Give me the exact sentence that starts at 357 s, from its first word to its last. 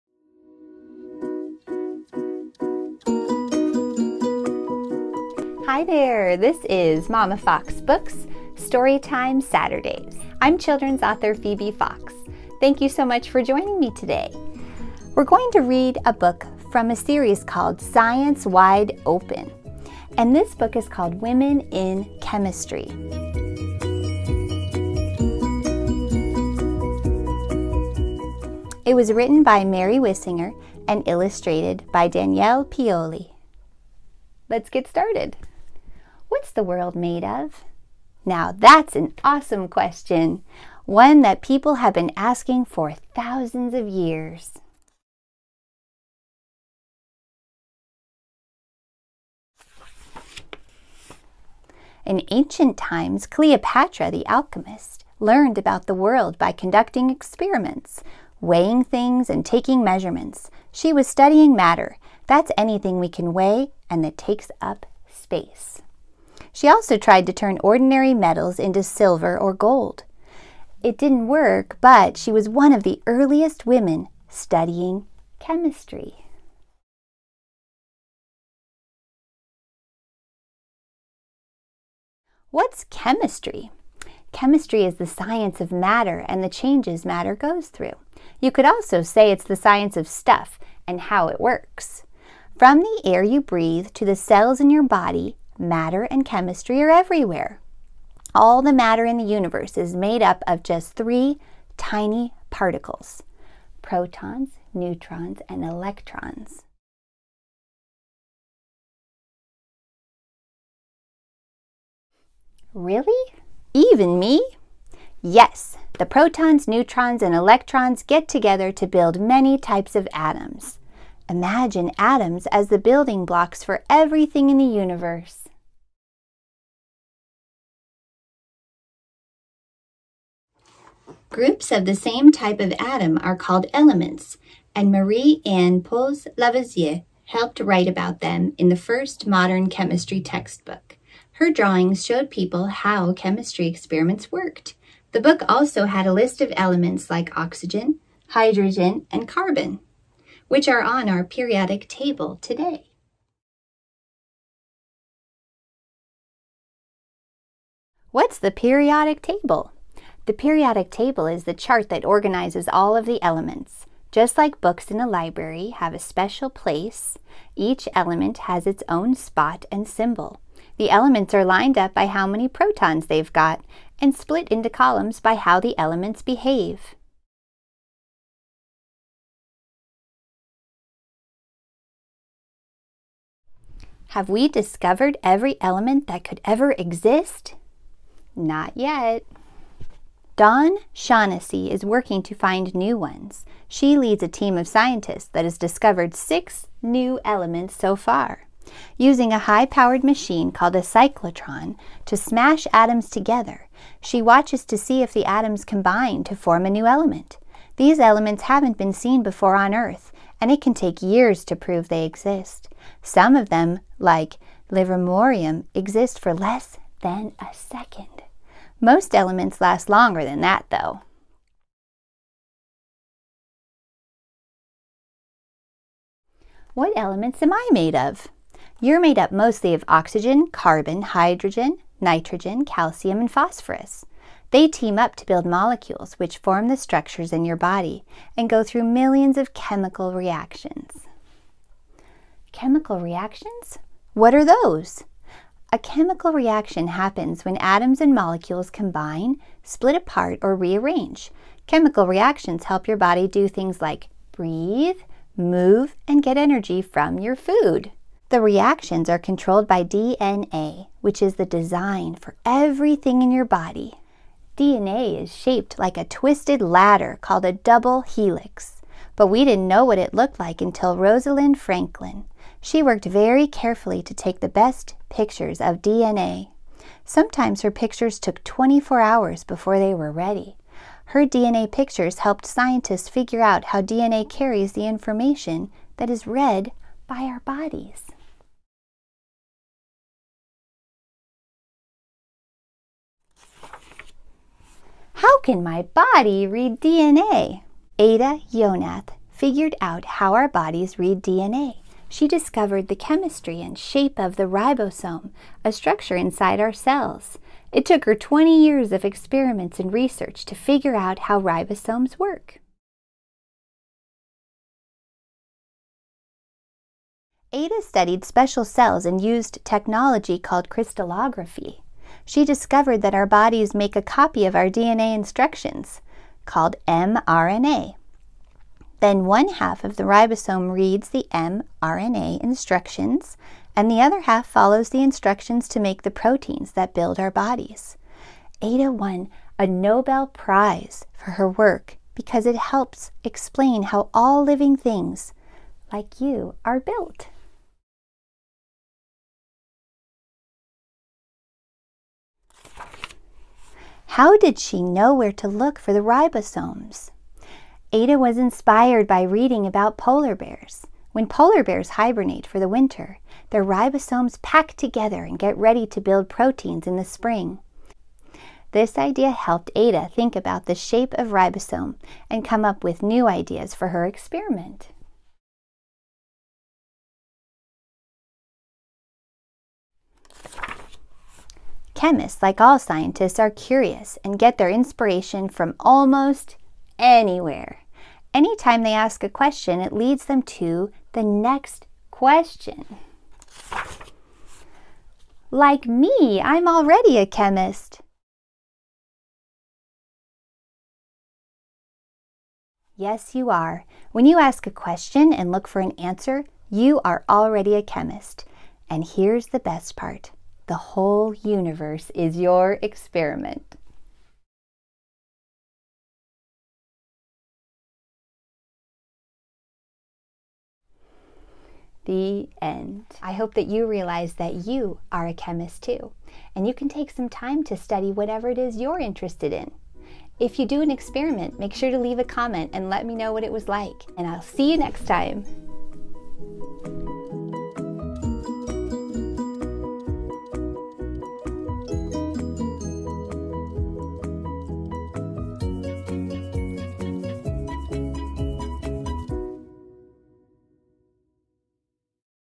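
Ada was inspired by reading about polar bears.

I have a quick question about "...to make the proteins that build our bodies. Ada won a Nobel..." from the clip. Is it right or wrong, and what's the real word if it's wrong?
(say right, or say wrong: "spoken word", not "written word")
right.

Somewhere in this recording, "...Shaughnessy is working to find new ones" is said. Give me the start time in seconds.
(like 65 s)
190 s.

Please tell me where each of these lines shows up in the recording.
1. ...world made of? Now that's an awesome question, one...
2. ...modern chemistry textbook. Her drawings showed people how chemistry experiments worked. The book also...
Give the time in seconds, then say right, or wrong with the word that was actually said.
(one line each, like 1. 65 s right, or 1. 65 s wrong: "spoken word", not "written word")
1. 36 s right
2. 139 s right.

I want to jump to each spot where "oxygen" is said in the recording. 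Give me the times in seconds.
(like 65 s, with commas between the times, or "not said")
147 s, 229 s.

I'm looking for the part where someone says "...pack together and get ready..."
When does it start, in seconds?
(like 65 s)
364 s.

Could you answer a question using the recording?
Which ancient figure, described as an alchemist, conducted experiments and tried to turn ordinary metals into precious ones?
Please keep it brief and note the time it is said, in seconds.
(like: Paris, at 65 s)
Cleopatra, at 53 s.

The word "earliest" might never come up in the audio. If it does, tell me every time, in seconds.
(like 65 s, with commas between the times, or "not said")
73 s.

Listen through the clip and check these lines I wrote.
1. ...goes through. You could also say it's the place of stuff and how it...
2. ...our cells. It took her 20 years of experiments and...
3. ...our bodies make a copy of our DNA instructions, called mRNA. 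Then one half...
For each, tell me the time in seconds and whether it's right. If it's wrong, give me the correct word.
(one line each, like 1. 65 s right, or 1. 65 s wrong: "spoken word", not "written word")
1. 87 s wrong: "science", not "place"
2. 306 s right
3. 323 s right.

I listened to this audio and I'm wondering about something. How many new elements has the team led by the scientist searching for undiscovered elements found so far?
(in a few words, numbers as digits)
6.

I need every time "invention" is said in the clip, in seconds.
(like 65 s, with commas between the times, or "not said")
not said.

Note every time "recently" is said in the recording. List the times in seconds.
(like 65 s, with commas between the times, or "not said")
not said.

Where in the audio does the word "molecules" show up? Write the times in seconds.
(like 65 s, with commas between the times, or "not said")
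235 s, 248 s.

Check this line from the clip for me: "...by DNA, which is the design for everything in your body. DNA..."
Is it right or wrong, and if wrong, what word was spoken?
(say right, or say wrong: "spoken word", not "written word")
right.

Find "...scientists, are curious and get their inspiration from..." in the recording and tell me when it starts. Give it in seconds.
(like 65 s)
382 s.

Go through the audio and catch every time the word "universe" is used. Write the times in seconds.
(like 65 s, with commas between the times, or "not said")
99 s, 124 s, 411 s.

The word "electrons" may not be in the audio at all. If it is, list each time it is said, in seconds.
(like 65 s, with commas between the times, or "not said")
105 s, 117 s.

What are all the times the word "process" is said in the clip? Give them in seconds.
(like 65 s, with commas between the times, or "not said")
not said.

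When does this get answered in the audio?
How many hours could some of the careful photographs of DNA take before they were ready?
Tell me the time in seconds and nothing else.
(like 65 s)
278 s.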